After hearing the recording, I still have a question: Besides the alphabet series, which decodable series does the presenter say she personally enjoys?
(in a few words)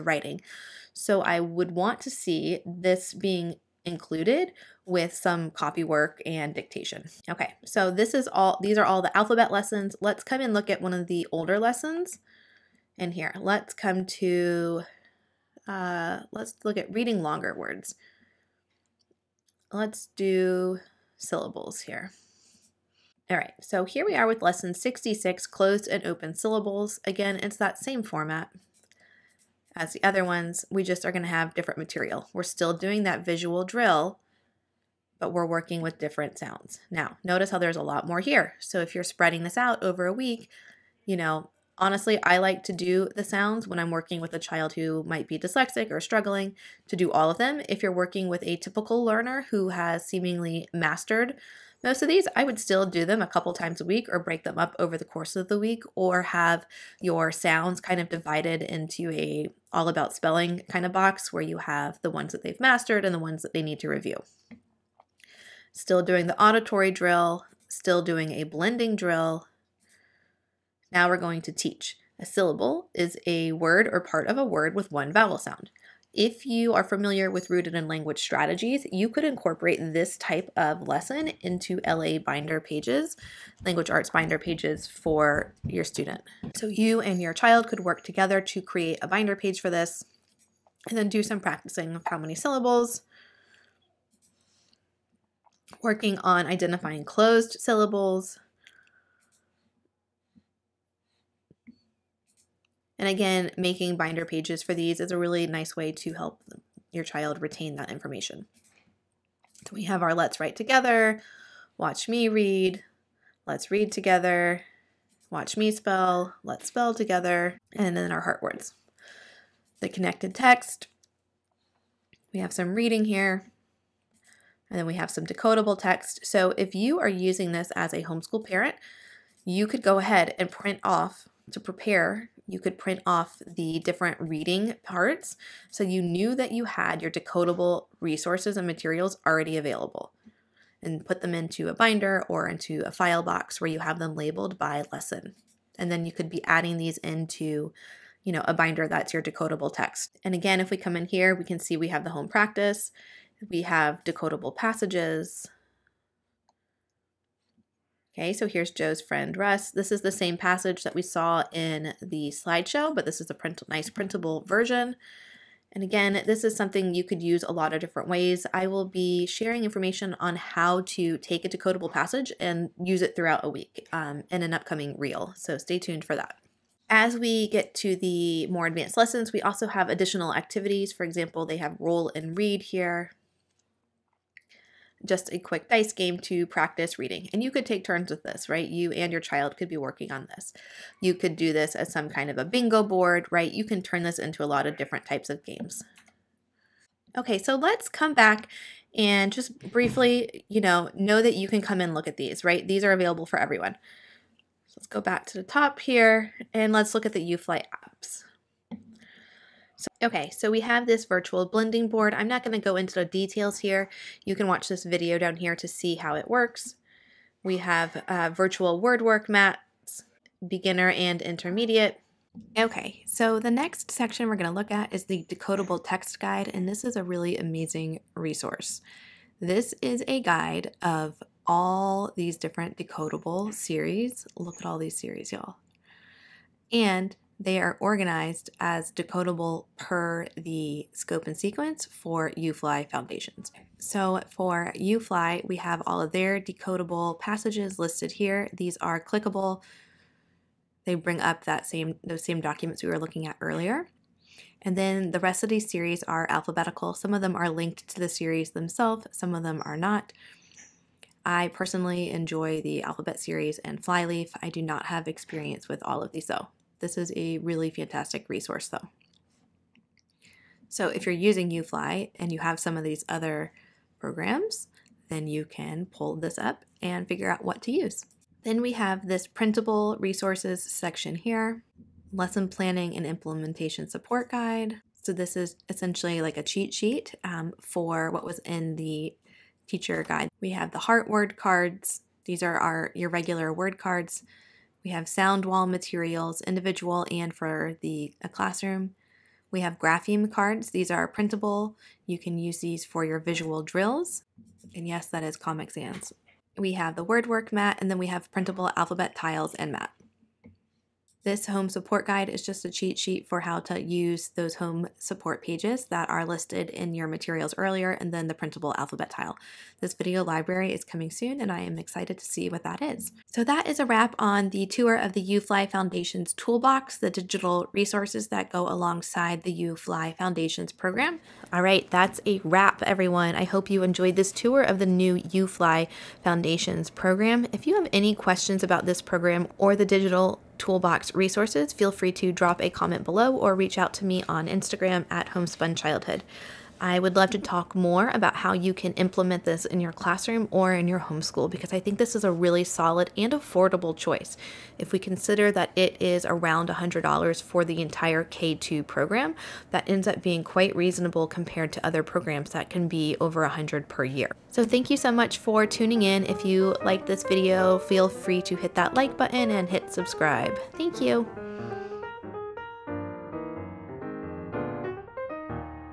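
Flyleaf.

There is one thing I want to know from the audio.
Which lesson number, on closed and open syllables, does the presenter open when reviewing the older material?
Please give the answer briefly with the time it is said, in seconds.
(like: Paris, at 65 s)
66, at 24 s.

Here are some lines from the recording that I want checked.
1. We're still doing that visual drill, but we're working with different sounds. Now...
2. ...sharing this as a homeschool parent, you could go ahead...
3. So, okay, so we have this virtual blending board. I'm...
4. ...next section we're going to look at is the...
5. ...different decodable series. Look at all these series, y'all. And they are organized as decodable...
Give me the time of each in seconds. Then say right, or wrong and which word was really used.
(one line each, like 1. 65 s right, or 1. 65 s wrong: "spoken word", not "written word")
1. 32 s right
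2. 127 s wrong: "using", not "sharing"
3. 209 s right
4. 223 s right
5. 232 s right.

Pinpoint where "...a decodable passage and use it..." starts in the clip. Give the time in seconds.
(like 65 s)
171 s.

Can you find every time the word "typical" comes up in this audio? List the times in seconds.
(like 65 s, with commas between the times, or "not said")
48 s.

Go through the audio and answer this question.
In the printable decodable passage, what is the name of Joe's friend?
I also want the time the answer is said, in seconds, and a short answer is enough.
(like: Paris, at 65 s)
Russ, at 159 s.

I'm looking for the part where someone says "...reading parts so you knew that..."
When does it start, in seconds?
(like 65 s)
134 s.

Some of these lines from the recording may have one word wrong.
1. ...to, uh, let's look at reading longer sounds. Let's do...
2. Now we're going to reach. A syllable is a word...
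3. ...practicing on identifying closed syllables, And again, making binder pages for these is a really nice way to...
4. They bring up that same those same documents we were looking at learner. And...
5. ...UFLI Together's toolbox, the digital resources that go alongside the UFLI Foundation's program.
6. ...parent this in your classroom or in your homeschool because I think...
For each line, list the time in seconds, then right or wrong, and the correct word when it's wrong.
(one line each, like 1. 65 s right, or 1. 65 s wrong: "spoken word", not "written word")
1. 14 s wrong: "words", not "sounds"
2. 70 s wrong: "teach", not "reach"
3. 95 s wrong: "working", not "practicing"
4. 250 s wrong: "earlier", not "learner"
5. 325 s wrong: "Foundation", not "Together"
6. 348 s wrong: "implement", not "parent".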